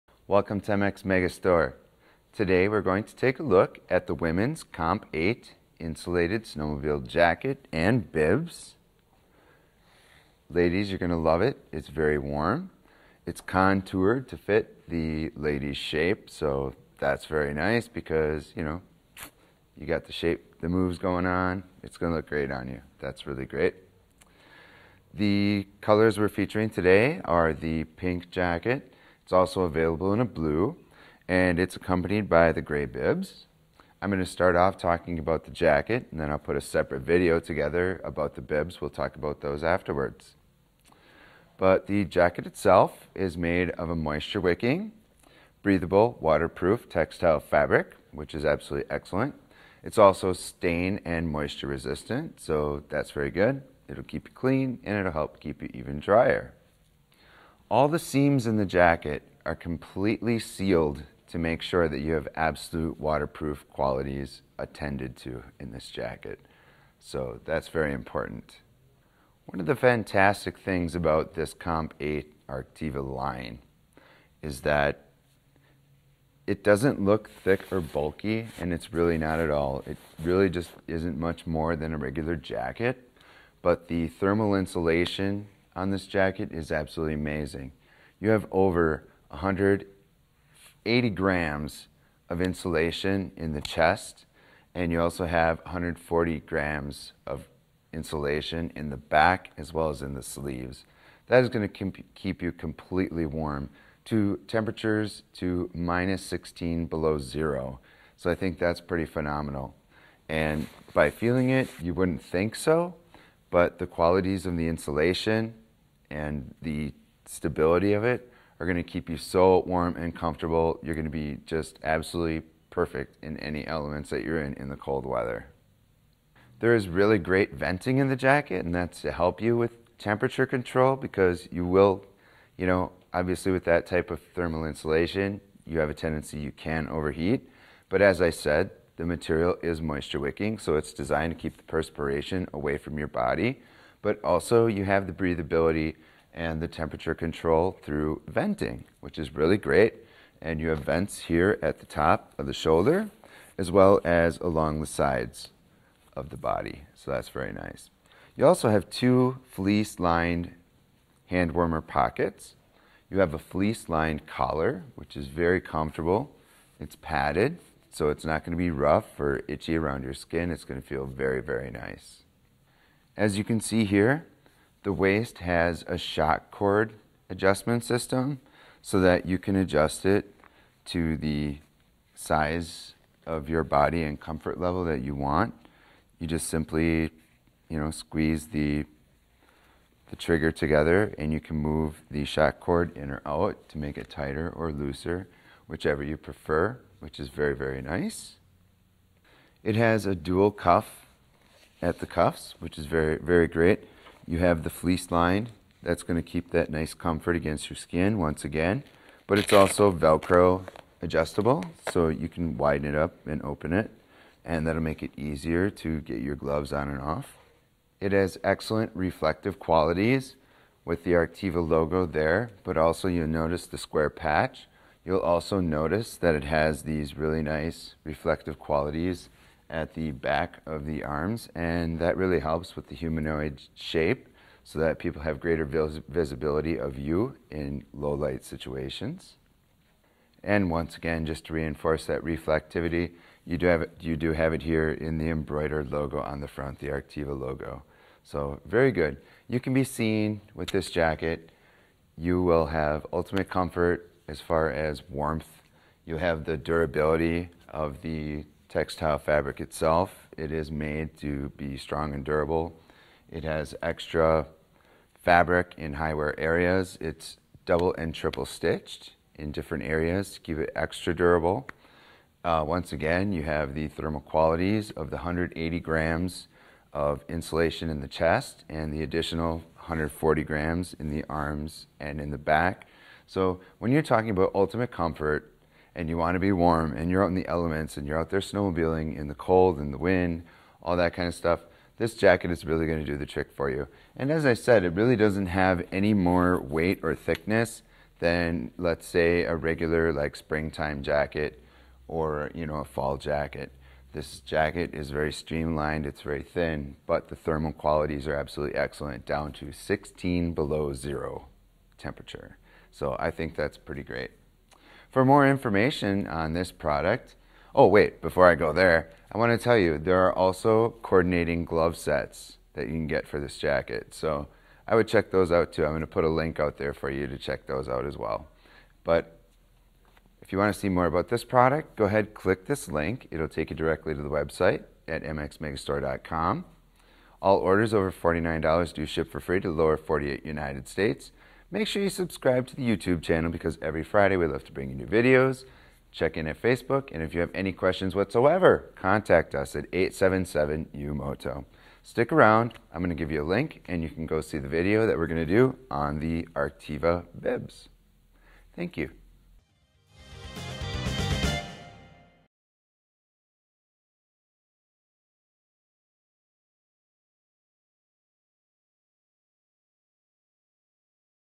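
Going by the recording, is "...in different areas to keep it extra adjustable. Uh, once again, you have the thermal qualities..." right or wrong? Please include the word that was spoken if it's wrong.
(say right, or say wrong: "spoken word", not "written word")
wrong: "durable", not "adjustable".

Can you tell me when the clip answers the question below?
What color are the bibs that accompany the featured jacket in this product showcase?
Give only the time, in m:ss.
0:32.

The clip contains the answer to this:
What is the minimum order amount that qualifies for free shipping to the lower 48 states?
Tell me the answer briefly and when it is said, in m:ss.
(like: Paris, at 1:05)
$49, at 5:38.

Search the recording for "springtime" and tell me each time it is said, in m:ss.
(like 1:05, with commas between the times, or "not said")
5:00.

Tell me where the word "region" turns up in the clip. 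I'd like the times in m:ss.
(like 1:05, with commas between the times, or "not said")
not said.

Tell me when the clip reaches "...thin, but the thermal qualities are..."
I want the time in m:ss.
5:06.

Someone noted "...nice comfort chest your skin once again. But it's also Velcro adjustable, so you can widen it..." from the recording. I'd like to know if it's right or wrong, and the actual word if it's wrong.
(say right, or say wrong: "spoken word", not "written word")
wrong: "against", not "chest".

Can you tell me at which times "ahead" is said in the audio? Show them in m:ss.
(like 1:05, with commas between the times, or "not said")
5:32.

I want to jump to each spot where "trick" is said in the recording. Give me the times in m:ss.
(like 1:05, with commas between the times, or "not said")
4:53.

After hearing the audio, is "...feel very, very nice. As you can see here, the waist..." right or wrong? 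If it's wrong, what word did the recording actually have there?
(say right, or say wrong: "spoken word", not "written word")
right.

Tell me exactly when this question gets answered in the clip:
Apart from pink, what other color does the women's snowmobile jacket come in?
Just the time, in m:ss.
0:30.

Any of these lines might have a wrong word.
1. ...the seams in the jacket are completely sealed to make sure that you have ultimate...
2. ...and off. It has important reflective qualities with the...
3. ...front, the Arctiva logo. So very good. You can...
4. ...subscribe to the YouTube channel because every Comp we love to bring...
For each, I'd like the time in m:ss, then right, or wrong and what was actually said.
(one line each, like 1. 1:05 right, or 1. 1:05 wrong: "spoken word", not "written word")
1. 0:57 wrong: "absolute", not "ultimate"
2. 3:36 wrong: "excellent", not "important"
3. 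4:06 right
4. 5:42 wrong: "Friday", not "Comp".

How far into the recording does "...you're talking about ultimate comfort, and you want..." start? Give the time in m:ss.
4:43.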